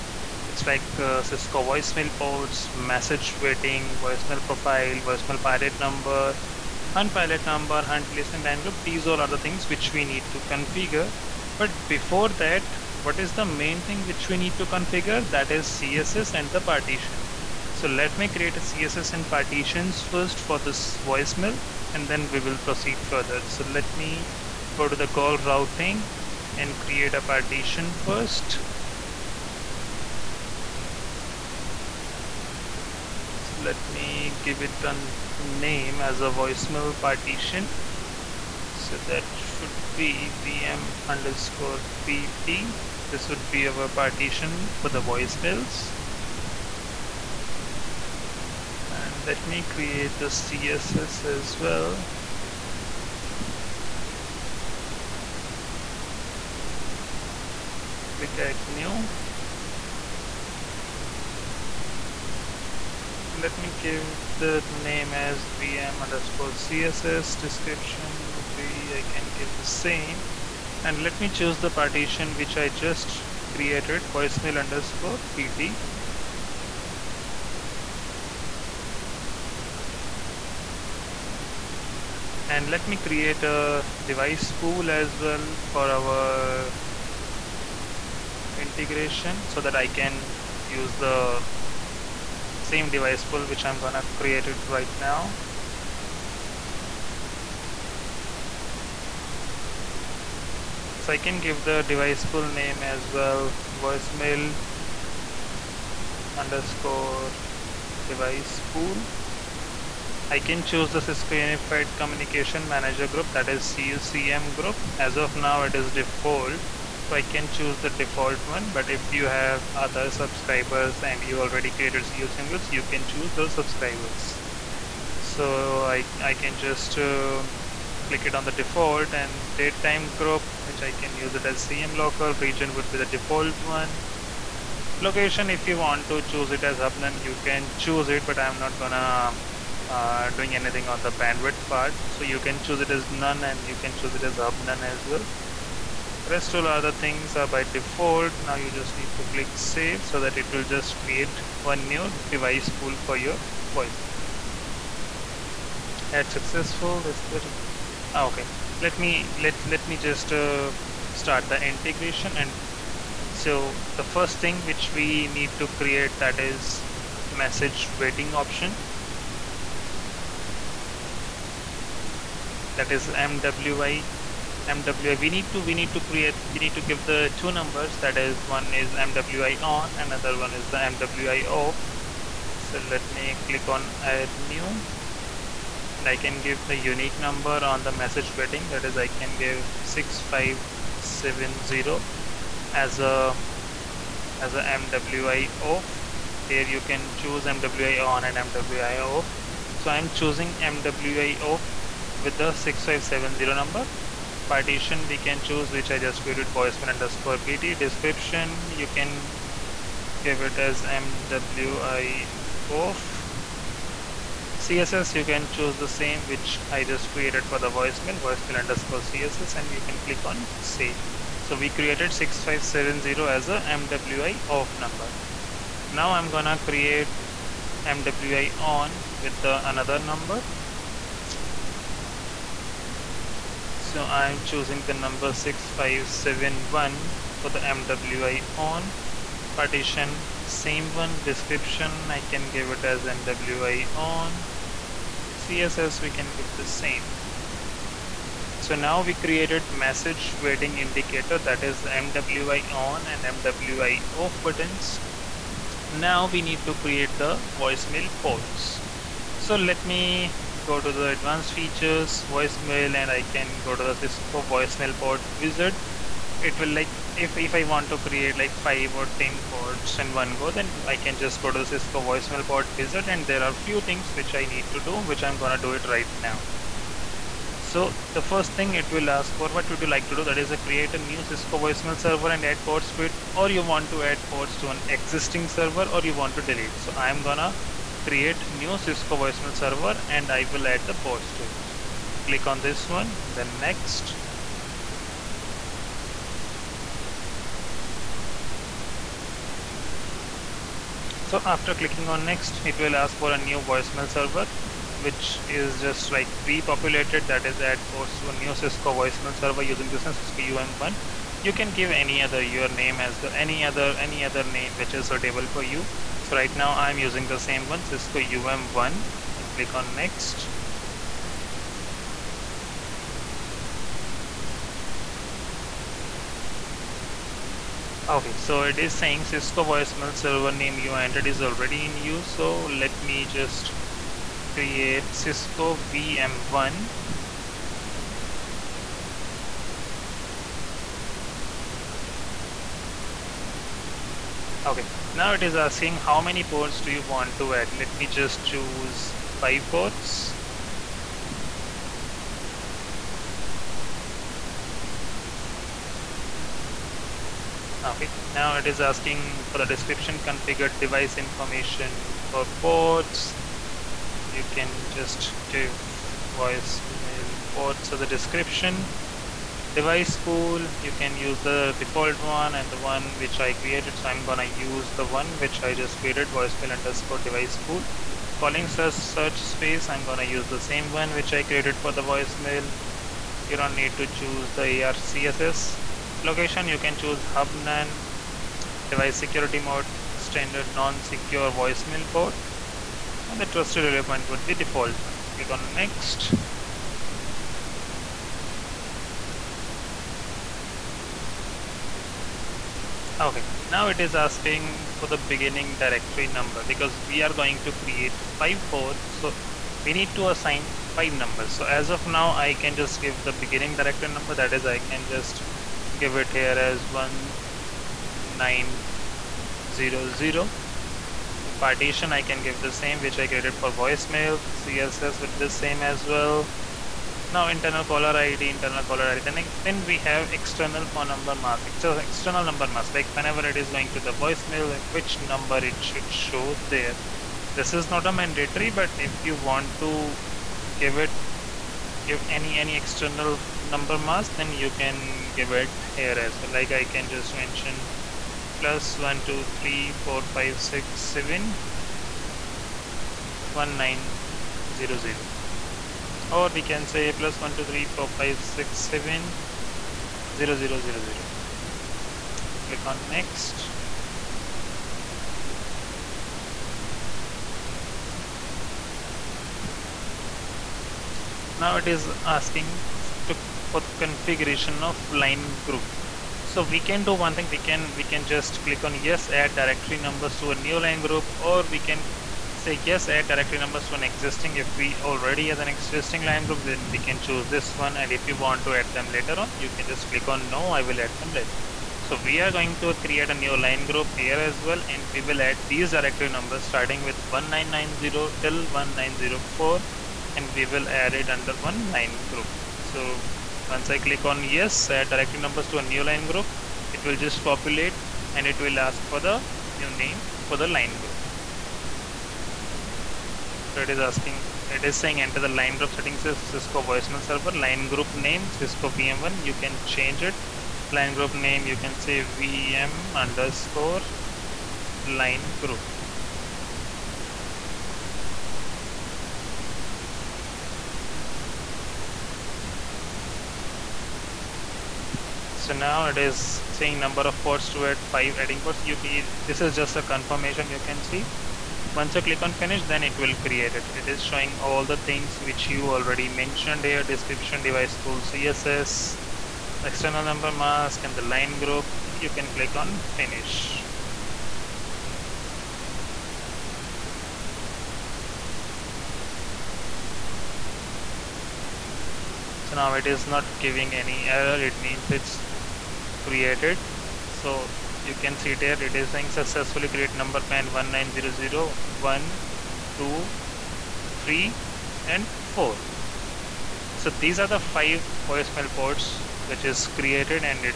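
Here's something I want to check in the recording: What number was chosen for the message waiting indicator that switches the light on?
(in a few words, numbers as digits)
6571.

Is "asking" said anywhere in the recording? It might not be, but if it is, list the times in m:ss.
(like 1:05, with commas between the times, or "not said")
5:45, 5:58, 6:44, 7:52, 8:33.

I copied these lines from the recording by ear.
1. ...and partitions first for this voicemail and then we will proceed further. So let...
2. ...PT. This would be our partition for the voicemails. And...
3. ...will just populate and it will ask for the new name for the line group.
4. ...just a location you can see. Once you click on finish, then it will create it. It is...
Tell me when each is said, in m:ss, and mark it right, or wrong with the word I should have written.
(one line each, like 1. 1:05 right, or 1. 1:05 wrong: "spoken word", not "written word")
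1. 0:19 right
2. 0:42 right
3. 8:27 right
4. 8:59 wrong: "confirmation", not "location".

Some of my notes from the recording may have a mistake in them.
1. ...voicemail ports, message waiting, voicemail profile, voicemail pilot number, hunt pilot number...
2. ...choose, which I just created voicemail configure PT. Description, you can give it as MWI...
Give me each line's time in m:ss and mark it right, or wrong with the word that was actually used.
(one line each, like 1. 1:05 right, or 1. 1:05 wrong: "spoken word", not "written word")
1. 0:01 right
2. 3:25 wrong: "underscore", not "configure".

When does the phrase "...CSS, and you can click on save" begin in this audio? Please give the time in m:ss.
3:39.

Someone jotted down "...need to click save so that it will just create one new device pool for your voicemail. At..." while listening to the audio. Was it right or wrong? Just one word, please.
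right.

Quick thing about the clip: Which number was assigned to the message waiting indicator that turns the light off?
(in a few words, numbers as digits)
6570.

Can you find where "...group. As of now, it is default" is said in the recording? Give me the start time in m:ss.
1:54.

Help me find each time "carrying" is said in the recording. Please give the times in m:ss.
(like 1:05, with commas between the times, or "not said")
not said.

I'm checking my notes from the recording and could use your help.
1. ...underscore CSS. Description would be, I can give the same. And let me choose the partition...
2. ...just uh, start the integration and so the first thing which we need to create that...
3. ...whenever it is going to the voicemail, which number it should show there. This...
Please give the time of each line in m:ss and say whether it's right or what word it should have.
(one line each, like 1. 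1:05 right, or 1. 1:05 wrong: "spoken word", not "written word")
1. 1:06 right
2. 2:39 right
3. 7:13 right.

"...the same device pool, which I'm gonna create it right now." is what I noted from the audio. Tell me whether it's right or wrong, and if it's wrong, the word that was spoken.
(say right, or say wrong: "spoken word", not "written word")
right.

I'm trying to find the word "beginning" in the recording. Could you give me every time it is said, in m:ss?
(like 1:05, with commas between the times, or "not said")
6:45, 6:53.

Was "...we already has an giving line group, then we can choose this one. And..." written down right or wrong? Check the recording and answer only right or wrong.
wrong.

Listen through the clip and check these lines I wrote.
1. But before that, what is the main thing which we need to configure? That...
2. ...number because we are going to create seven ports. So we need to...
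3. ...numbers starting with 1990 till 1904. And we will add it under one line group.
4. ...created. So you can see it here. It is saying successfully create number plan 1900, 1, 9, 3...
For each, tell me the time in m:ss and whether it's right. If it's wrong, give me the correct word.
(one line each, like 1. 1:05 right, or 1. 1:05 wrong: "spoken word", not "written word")
1. 0:11 right
2. 6:46 wrong: "five", not "seven"
3. 8:16 right
4. 9:26 wrong: "2", not "9".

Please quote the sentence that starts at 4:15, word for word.
Now we need to create the voicemail ports.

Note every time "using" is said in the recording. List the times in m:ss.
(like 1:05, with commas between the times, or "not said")
5:09, 5:17.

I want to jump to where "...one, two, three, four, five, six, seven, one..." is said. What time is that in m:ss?
7:28.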